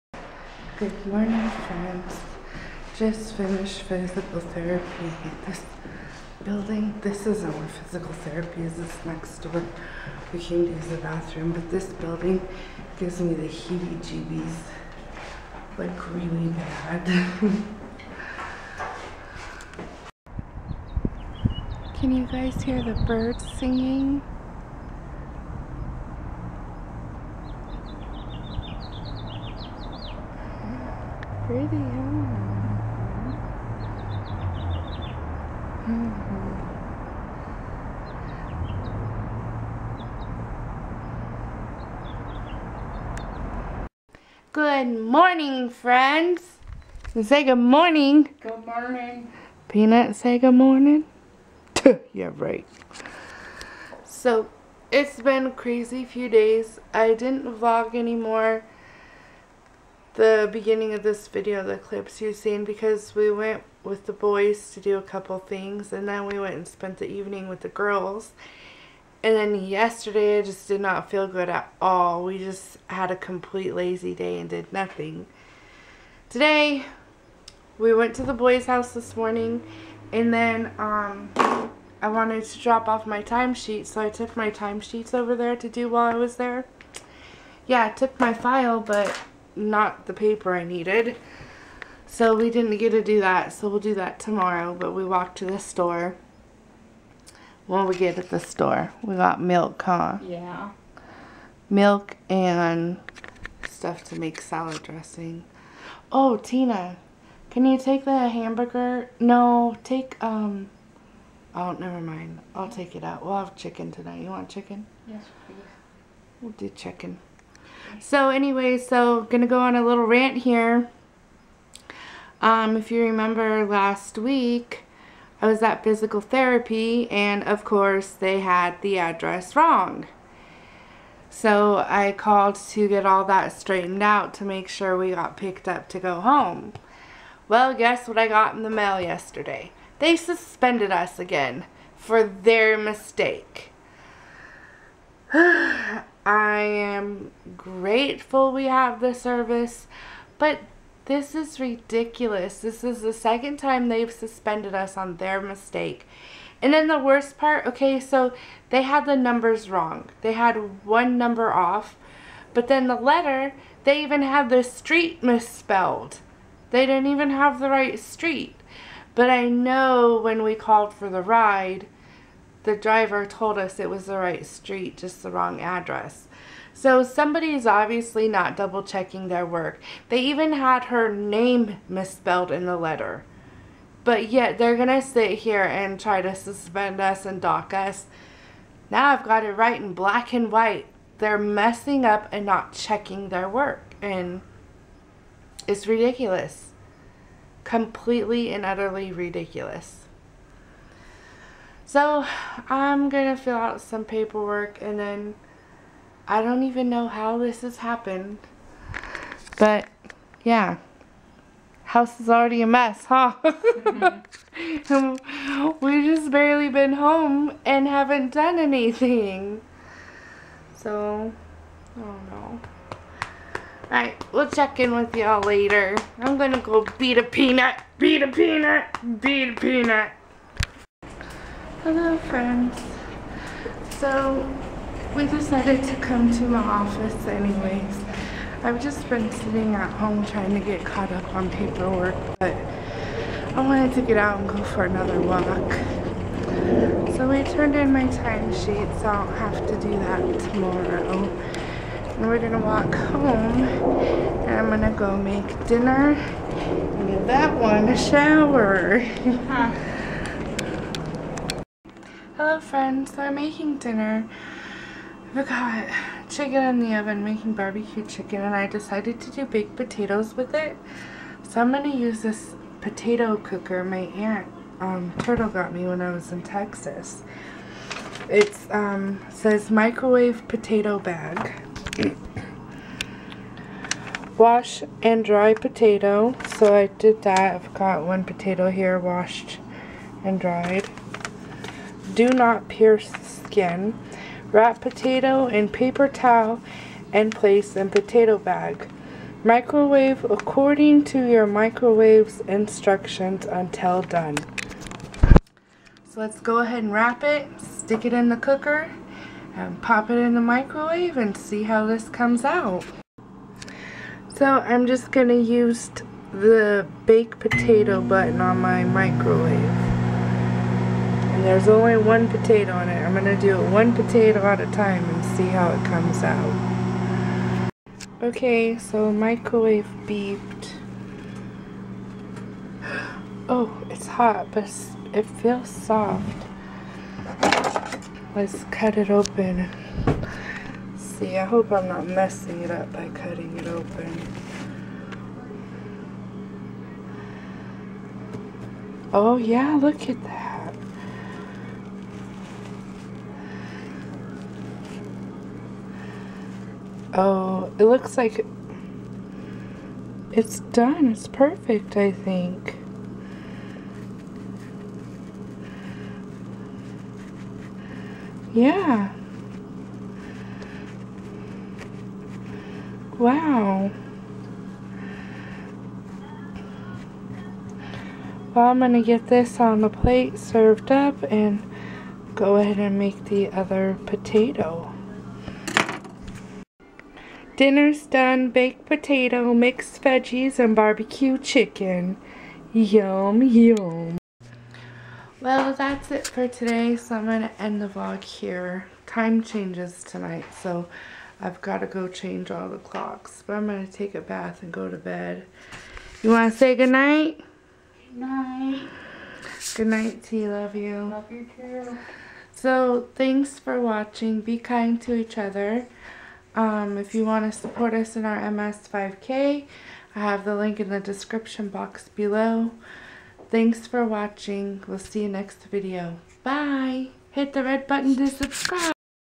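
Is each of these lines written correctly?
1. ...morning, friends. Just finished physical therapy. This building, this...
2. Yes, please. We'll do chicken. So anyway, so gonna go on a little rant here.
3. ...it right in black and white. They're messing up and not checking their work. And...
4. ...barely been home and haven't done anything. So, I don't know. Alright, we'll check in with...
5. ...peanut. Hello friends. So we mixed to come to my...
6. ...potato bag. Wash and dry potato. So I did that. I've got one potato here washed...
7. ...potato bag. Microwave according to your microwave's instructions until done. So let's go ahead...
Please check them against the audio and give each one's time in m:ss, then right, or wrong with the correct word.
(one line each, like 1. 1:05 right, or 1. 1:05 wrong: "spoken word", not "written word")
1. 0:01 right
2. 1:55 right
3. 3:09 right
4. 3:36 right
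5. 3:49 wrong: "decided", not "mixed"
6. 4:40 right
7. 4:57 right.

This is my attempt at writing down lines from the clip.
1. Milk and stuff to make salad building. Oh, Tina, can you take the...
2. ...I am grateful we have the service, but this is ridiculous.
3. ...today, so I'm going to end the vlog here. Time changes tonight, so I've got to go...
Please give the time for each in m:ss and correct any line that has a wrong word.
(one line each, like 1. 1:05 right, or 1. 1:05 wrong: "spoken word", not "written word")
1. 1:41 wrong: "dressing", not "building"
2. 2:26 right
3. 6:36 right.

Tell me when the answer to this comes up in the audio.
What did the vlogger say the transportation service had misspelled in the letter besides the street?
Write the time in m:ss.
3:00.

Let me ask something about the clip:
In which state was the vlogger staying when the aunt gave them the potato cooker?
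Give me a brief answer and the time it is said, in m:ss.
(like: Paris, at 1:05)
Texas, at 4:36.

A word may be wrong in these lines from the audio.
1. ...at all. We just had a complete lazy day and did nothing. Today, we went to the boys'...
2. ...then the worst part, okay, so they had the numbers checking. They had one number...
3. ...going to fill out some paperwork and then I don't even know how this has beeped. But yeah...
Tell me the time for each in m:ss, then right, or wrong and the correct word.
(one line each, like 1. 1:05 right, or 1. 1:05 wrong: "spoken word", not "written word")
1. 1:11 right
2. 2:36 wrong: "wrong", not "checking"
3. 3:23 wrong: "happened", not "beeped".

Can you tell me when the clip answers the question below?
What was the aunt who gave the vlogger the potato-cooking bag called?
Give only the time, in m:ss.
4:35.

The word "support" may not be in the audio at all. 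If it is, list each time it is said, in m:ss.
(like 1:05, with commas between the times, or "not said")
6:57.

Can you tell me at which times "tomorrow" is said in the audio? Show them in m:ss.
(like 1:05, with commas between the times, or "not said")
1:34, 4:10.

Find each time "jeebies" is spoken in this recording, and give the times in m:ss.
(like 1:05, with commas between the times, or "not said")
0:14.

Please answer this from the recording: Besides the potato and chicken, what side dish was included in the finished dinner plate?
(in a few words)
Mixed veggies.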